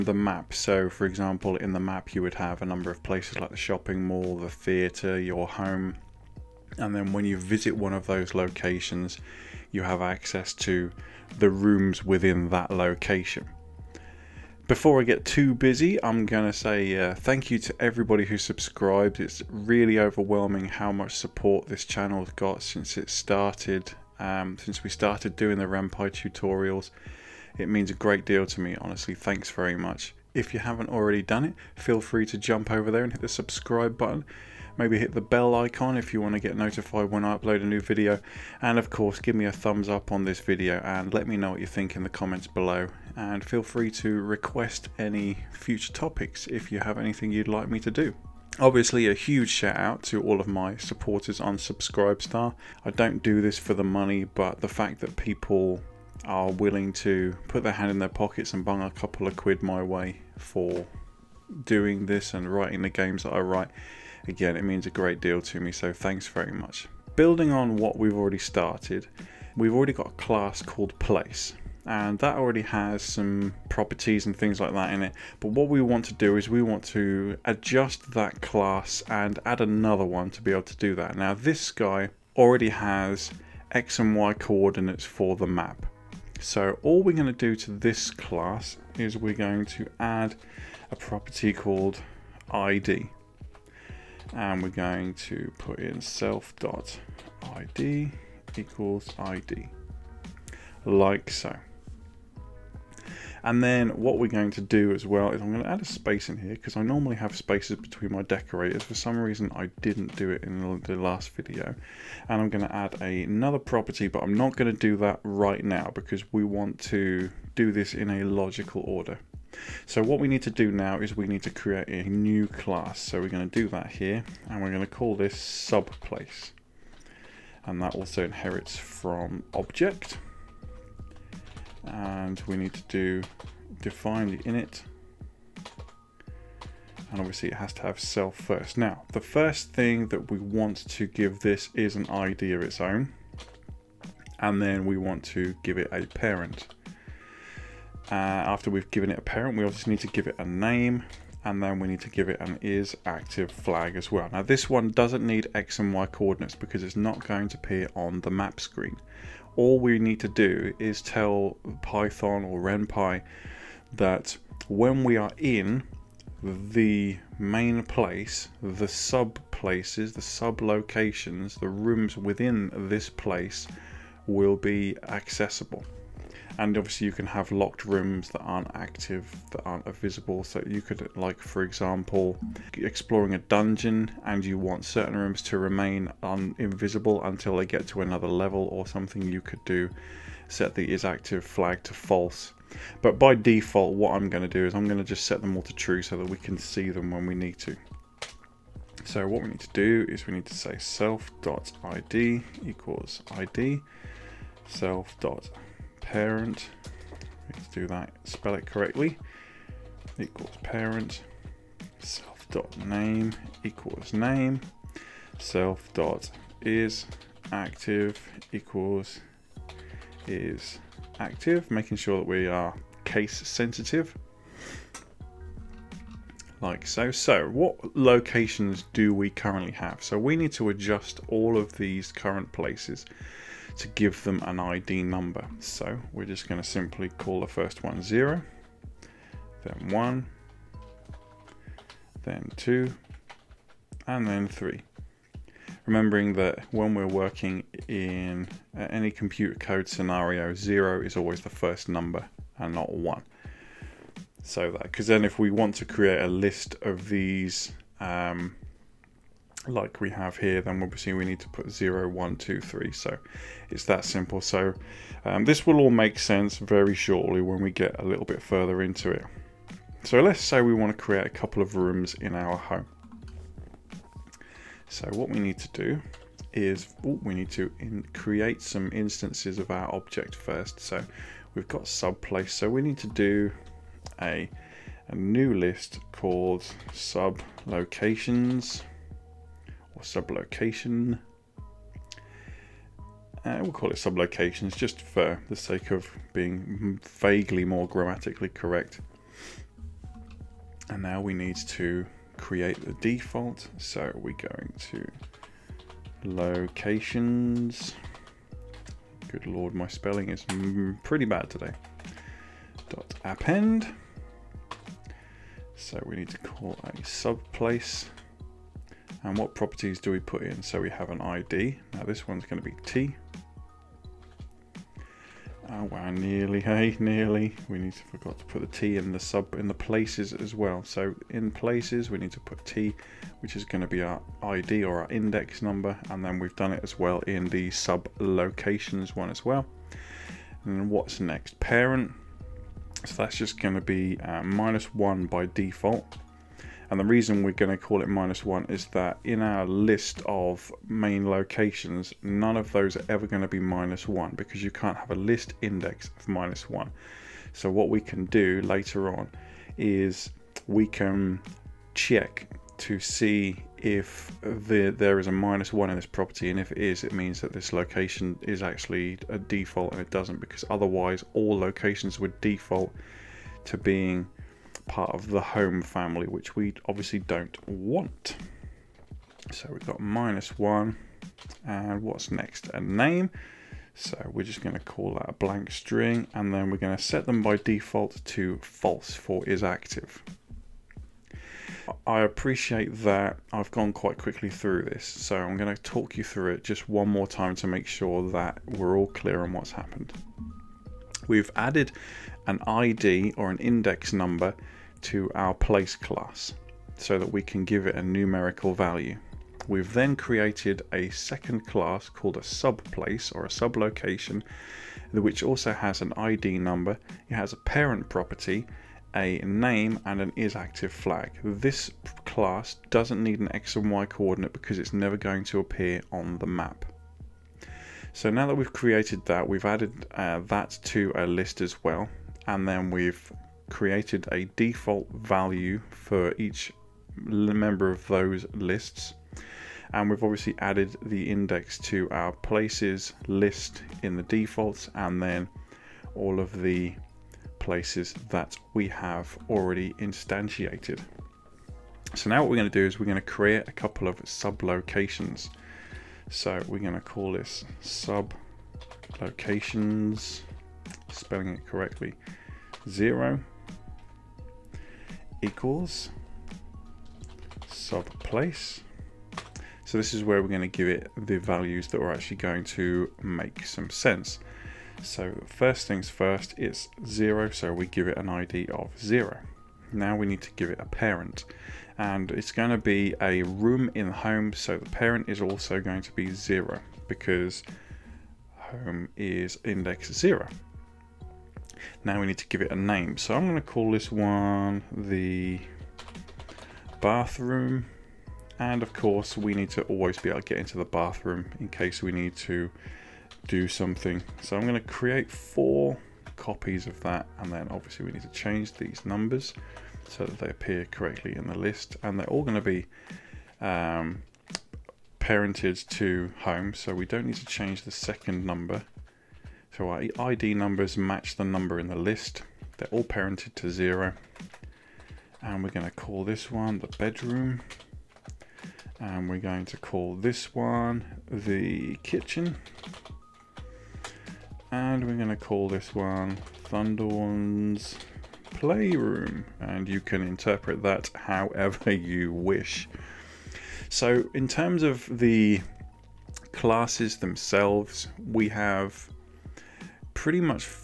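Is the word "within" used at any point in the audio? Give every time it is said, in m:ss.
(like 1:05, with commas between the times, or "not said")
0:12, 2:52.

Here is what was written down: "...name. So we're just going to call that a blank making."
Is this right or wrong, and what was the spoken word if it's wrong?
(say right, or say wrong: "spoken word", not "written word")
wrong: "string", not "making".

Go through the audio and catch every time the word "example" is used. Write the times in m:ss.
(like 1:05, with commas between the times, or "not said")
0:01, 3:01.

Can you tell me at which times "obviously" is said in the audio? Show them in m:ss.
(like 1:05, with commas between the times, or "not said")
0:48, 2:17, 2:29, 2:56, 4:20, 6:16, 7:20, 8:27.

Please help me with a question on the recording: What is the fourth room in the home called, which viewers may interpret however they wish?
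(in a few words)
Thundorn's playroom.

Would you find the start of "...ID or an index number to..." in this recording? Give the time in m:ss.
6:42.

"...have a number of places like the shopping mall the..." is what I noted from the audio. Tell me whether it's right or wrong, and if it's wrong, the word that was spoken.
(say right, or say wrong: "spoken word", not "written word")
right.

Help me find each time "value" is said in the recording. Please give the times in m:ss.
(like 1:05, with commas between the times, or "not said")
6:48, 7:15, 7:51.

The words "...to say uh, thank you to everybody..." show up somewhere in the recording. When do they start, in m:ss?
0:16.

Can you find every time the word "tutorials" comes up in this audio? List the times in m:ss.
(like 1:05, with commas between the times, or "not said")
0:26.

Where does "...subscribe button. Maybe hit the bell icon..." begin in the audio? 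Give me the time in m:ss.
0:33.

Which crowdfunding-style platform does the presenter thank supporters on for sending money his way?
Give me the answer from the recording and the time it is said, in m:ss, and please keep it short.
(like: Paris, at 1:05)
Subscribestar, at 0:51.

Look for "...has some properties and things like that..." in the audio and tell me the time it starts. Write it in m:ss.
1:12.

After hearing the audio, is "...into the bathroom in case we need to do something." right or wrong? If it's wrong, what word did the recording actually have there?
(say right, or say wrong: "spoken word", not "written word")
right.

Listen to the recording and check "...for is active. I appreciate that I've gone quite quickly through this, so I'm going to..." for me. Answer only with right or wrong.
right.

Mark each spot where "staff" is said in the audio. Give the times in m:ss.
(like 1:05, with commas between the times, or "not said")
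not said.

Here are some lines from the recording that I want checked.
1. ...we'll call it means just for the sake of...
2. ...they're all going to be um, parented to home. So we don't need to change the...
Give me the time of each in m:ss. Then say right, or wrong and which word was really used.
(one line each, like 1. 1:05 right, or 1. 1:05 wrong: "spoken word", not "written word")
1. 4:53 wrong: "sublocations", not "means"
2. 8:32 right.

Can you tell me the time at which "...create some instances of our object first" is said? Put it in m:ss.
4:38.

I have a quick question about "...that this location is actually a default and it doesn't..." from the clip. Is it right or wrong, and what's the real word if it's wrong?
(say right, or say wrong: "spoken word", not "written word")
right.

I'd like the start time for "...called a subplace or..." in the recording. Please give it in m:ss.
6:52.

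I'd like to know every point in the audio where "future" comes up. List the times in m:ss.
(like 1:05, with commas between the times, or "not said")
0:45.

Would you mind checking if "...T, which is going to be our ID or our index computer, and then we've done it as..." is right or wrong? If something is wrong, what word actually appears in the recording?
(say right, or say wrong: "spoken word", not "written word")
wrong: "number", not "computer".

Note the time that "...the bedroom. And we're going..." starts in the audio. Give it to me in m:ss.
8:46.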